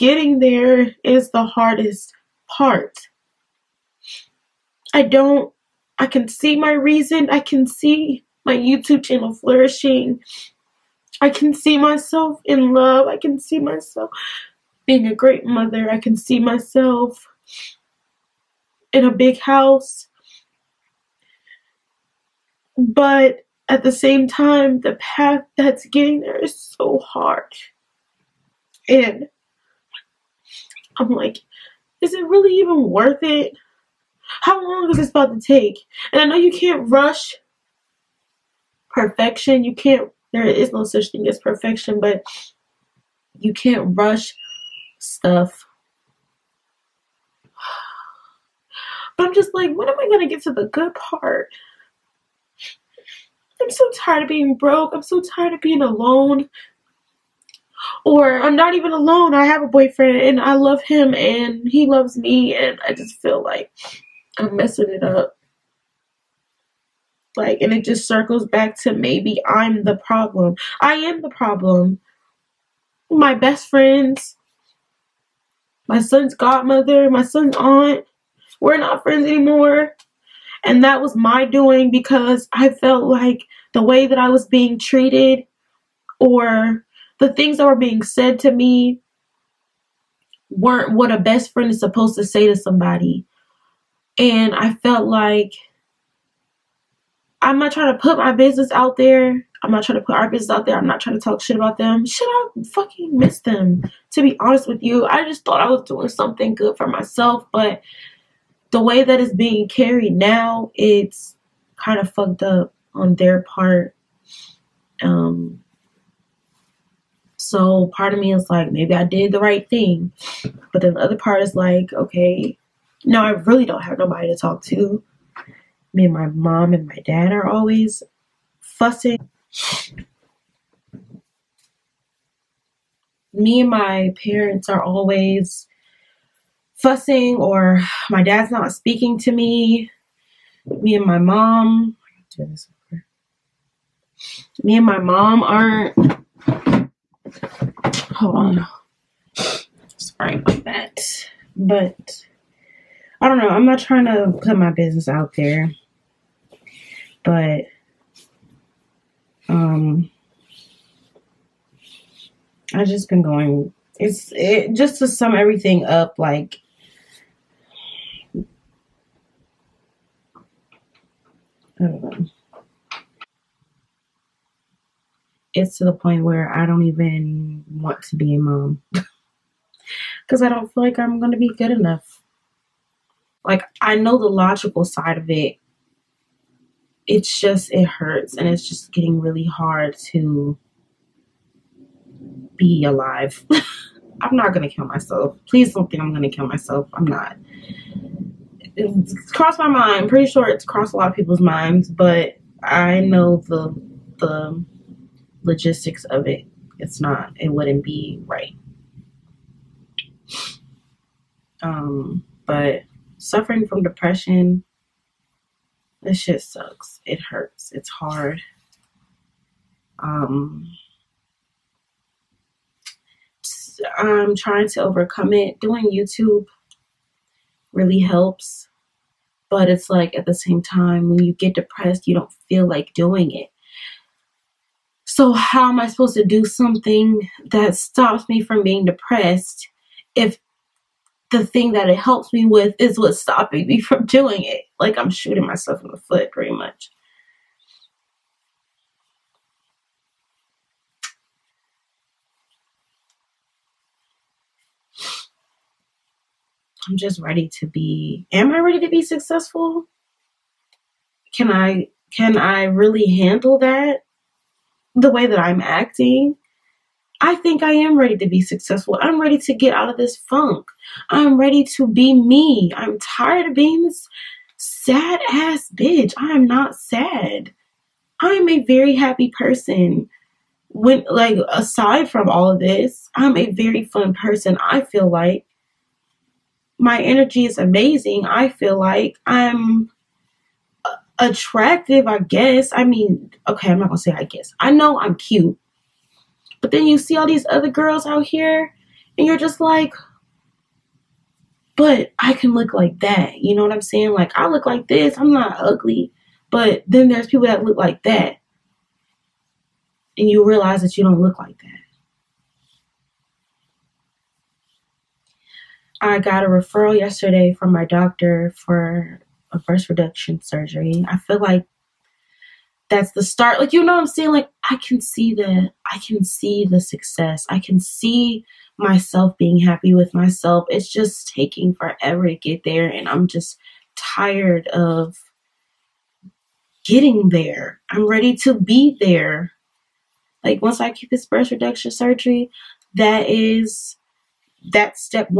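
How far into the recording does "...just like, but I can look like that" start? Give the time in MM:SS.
04:59.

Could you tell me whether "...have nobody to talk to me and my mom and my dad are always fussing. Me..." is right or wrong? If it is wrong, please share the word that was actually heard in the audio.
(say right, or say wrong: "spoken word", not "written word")
right.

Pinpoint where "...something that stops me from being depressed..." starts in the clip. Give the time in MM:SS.
03:56.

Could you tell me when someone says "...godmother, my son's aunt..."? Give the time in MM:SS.
01:16.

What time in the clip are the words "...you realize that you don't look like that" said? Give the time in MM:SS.
05:10.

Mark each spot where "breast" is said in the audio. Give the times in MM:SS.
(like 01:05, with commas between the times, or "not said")
05:19, 05:41.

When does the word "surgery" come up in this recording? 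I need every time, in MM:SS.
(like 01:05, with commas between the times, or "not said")
05:20, 05:41.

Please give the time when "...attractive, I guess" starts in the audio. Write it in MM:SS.
04:51.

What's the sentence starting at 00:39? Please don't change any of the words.
You can't there is no such thing as perfection, but you can't rush stuff.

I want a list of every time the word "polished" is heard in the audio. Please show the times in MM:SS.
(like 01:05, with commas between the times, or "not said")
not said.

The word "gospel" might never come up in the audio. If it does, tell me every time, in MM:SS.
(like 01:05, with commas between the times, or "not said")
not said.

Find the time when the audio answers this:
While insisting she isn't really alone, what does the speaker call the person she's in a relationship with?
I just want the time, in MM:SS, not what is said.
00:59.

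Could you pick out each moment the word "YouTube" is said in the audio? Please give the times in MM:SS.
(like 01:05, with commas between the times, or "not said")
00:08, 03:45.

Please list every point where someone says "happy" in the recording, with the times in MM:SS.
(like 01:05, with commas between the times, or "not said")
04:38, 05:29.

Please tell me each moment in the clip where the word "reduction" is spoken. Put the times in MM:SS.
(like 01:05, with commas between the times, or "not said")
05:19, 05:41.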